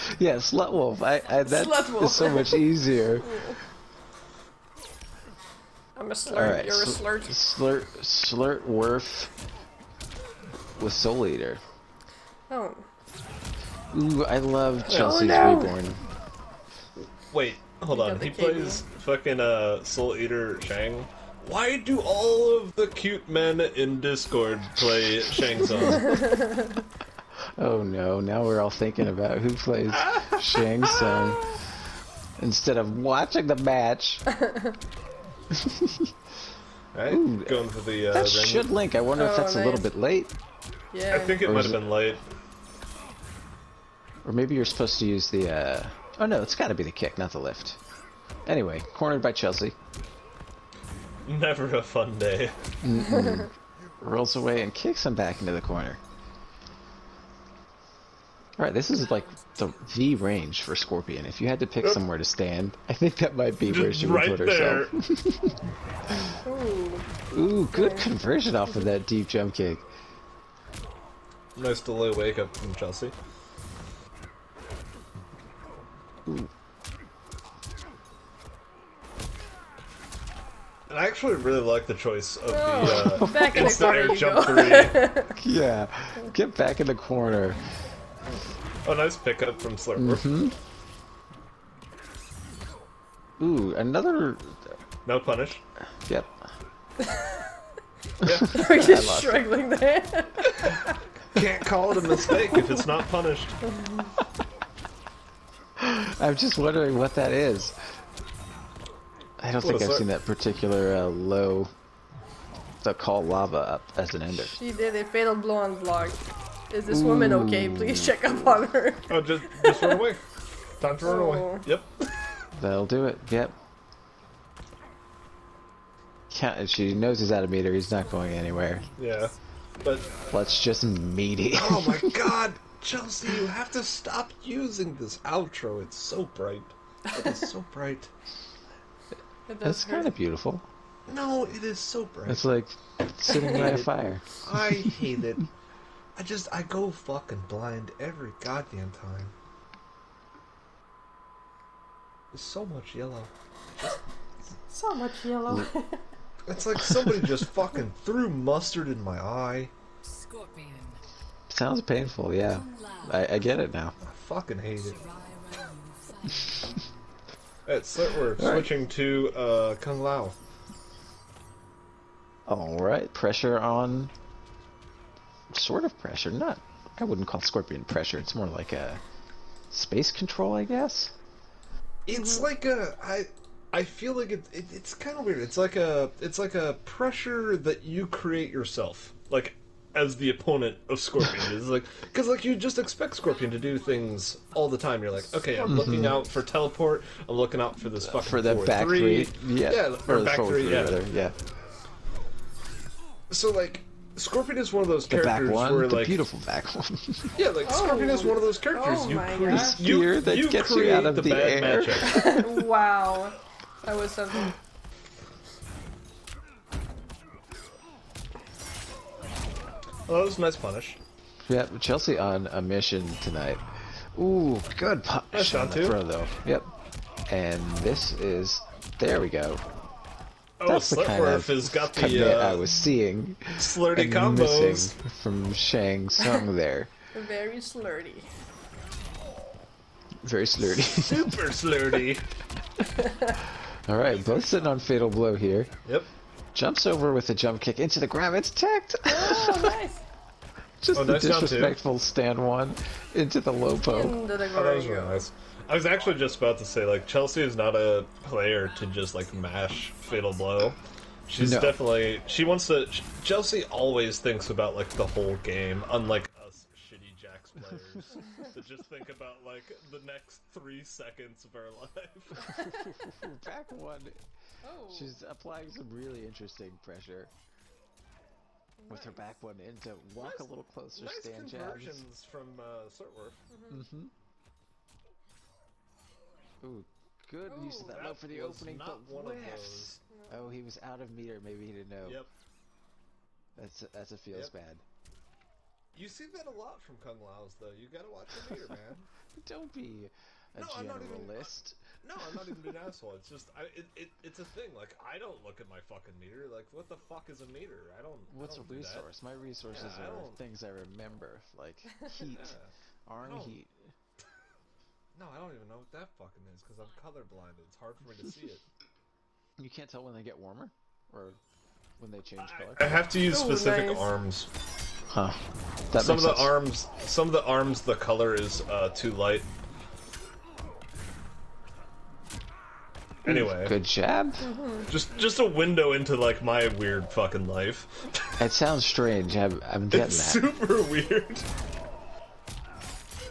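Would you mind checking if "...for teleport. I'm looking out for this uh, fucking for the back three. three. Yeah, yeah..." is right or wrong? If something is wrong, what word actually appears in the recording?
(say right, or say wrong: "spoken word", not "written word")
right.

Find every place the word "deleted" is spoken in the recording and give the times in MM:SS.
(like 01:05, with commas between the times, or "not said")
not said.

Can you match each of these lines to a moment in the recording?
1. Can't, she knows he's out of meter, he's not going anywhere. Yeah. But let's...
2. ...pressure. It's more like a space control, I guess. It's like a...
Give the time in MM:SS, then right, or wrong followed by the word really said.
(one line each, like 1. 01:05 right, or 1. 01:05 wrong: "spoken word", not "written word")
1. 02:06 right
2. 02:57 right.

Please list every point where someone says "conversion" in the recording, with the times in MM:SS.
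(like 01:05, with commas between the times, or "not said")
01:07, 04:41.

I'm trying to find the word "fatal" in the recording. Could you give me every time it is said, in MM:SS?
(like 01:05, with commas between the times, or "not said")
01:55, 04:04, 04:20.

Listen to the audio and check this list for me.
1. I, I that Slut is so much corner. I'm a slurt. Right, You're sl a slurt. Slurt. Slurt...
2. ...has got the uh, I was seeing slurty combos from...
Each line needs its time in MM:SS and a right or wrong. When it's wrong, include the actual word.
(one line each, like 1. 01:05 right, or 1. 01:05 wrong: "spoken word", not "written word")
1. 00:01 wrong: "easier", not "corner"
2. 03:51 right.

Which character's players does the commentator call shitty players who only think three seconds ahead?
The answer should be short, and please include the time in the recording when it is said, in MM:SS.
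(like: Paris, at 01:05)
Jax, at 04:27.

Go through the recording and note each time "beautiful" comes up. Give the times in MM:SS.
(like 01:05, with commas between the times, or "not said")
02:20, 03:26.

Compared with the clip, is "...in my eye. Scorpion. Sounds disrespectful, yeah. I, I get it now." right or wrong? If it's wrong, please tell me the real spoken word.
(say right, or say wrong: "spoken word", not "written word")
wrong: "painful", not "disrespectful".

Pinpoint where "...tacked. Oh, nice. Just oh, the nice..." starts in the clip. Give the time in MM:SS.
04:08.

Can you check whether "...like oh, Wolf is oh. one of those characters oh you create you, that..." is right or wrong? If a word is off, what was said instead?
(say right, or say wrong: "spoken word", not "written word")
wrong: "Scorpion", not "Wolf".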